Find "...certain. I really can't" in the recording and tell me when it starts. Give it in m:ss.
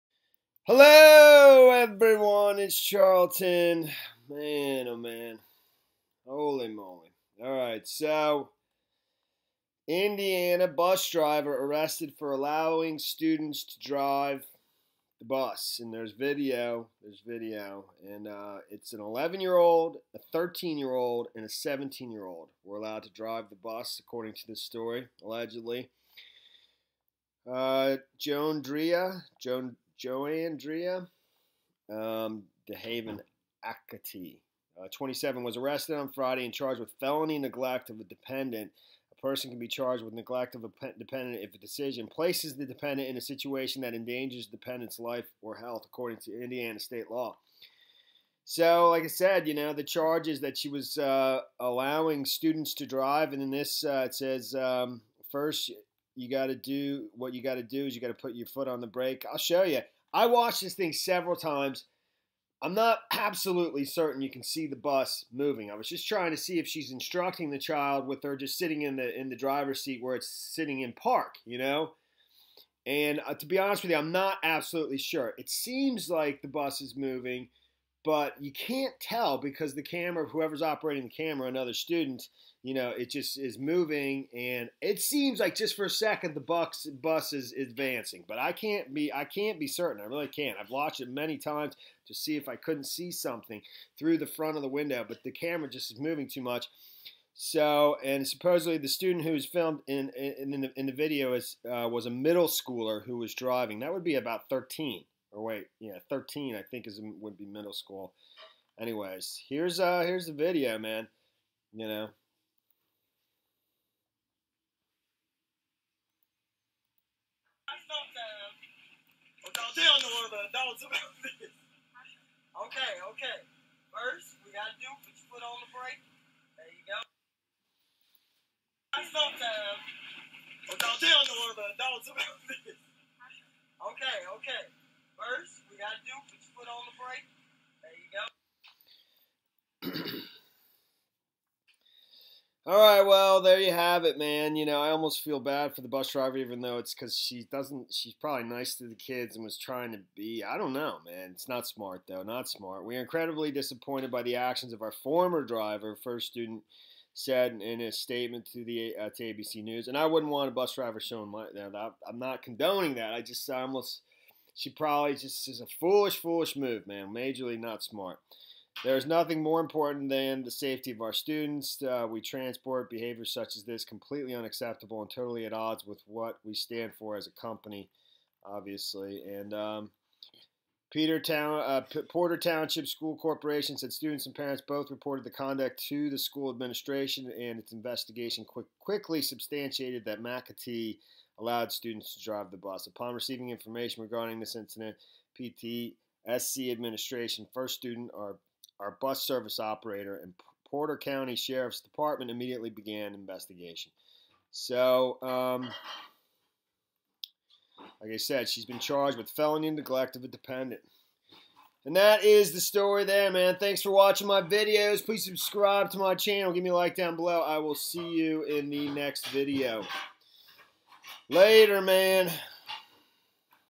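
1:29.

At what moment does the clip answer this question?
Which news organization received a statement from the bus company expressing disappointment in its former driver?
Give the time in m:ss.
2:39.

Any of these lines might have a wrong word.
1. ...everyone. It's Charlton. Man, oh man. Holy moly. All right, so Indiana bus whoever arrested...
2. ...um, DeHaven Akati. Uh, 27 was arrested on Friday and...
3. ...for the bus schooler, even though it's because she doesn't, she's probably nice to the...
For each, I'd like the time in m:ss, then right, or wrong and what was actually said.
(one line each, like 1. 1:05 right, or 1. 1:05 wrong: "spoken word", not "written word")
1. 0:01 wrong: "driver", not "whoever"
2. 0:31 right
3. 2:25 wrong: "driver", not "schooler".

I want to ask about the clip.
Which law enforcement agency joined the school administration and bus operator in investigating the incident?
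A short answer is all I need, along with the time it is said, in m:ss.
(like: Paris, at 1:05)
Porter County Sheriff's Department, at 3:20.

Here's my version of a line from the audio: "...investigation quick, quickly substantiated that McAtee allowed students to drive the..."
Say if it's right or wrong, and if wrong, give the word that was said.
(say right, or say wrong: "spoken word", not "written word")
right.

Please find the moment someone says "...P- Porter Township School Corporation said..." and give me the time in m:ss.
3:01.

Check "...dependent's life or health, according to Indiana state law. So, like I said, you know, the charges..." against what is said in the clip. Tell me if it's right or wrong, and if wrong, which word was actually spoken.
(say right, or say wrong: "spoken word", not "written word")
right.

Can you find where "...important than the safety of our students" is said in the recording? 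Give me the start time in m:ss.
2:49.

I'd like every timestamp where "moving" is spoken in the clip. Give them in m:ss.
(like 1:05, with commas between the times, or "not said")
1:05, 1:16, 1:23, 1:35.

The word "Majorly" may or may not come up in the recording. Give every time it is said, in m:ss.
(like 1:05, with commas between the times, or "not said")
2:47.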